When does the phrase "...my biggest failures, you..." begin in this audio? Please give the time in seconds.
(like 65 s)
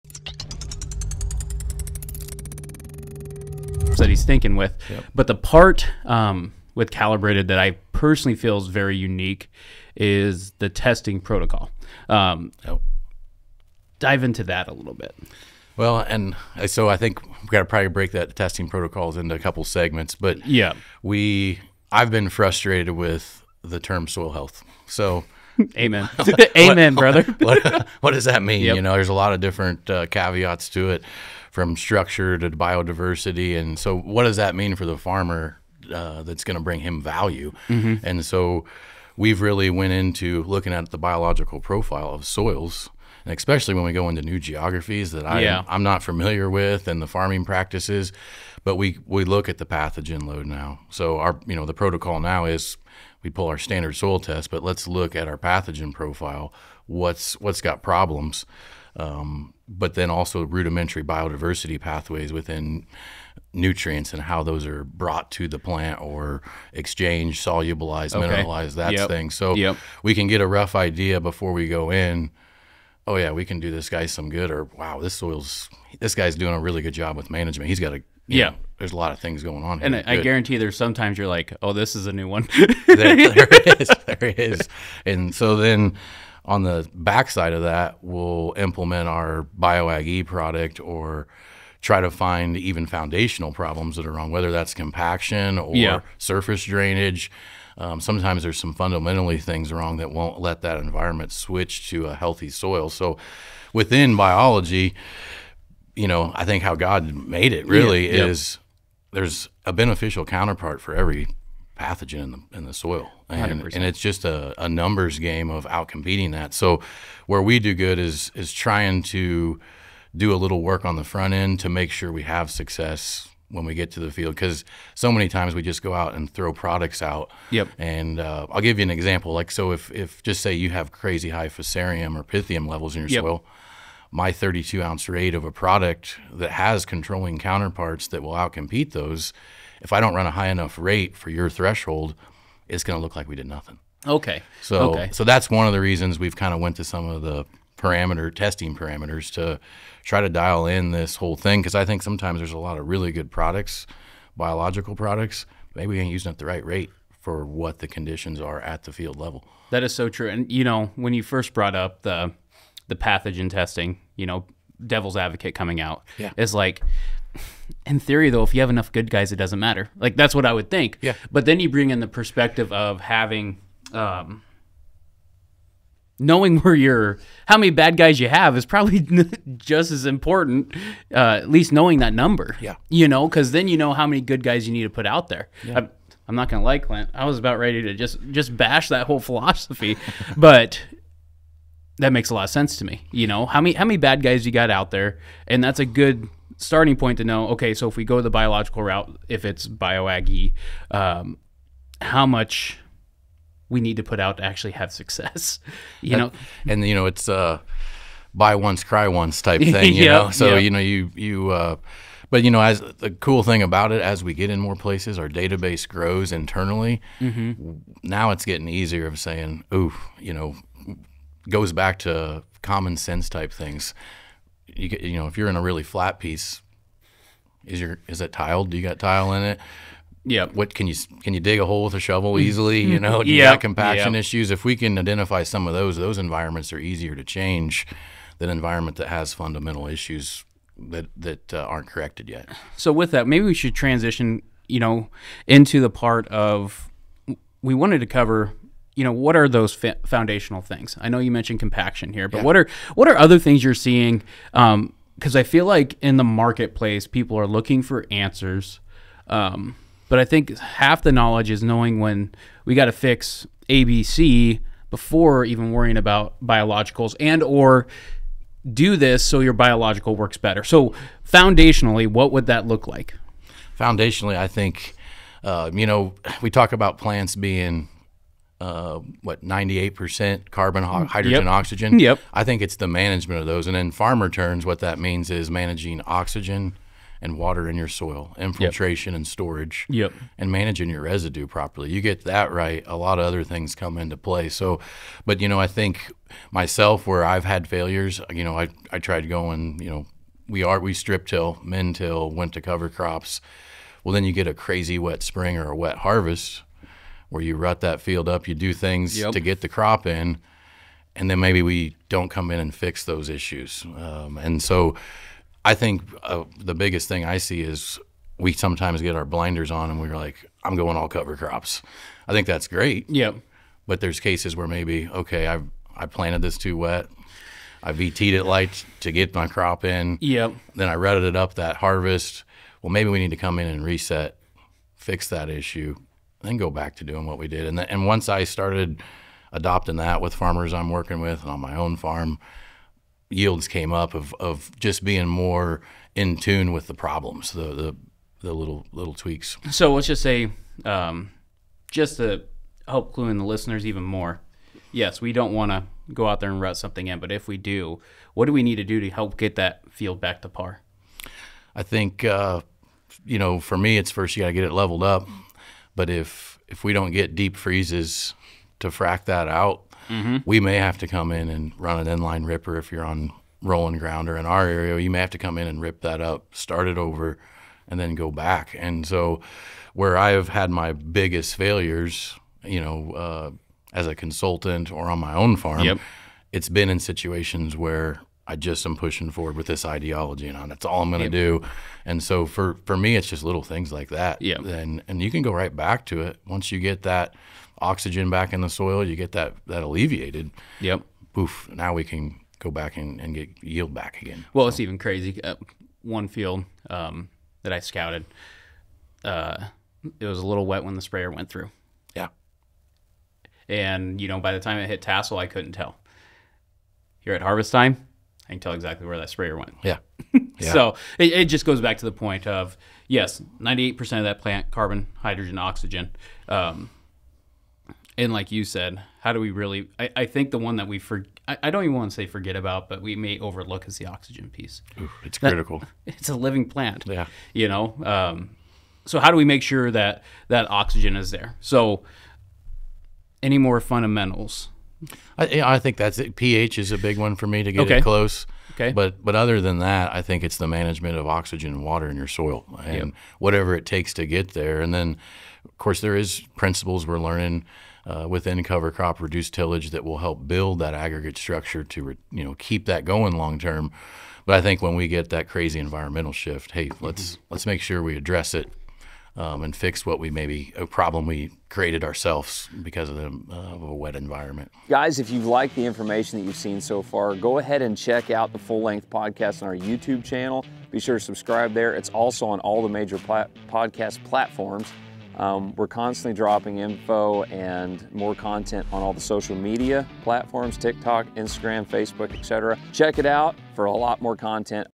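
380 s.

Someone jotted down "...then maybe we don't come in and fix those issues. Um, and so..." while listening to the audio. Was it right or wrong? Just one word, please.
right.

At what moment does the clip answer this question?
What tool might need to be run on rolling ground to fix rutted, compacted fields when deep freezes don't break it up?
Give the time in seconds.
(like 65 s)
372 s.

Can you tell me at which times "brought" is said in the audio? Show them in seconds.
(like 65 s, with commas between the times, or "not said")
64 s, 161 s.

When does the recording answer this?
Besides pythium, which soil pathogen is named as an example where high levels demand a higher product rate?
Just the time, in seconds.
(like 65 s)
131 s.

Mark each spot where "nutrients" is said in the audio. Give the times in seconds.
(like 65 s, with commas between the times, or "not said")
63 s.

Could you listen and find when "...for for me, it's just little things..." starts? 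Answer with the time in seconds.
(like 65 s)
392 s.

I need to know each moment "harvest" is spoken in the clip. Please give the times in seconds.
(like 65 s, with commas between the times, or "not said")
305 s, 331 s, 417 s.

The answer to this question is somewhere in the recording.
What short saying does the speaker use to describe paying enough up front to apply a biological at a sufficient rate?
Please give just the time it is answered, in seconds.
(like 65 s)
208 s.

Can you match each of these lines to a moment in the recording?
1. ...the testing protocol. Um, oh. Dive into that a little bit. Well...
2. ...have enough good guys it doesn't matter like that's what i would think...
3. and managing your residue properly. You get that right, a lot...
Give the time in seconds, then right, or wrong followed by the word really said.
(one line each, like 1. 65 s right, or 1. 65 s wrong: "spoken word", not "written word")
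1. 10 s right
2. 168 s right
3. 290 s right.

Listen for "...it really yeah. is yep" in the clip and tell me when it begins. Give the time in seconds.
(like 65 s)
107 s.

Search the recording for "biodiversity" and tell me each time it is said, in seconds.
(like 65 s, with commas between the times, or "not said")
32 s, 61 s.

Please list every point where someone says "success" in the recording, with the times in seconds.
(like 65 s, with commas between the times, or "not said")
122 s, 204 s.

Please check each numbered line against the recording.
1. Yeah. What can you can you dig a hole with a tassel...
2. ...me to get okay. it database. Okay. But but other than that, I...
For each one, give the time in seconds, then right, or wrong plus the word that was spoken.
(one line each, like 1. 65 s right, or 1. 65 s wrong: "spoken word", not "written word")
1. 230 s wrong: "shovel", not "tassel"
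2. 447 s wrong: "close", not "database".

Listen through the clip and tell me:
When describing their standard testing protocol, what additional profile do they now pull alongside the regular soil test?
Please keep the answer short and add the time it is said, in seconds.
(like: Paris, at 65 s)
pathogen profile, at 55 s.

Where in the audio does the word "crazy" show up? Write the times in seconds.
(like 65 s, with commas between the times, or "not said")
130 s, 304 s, 404 s, 465 s.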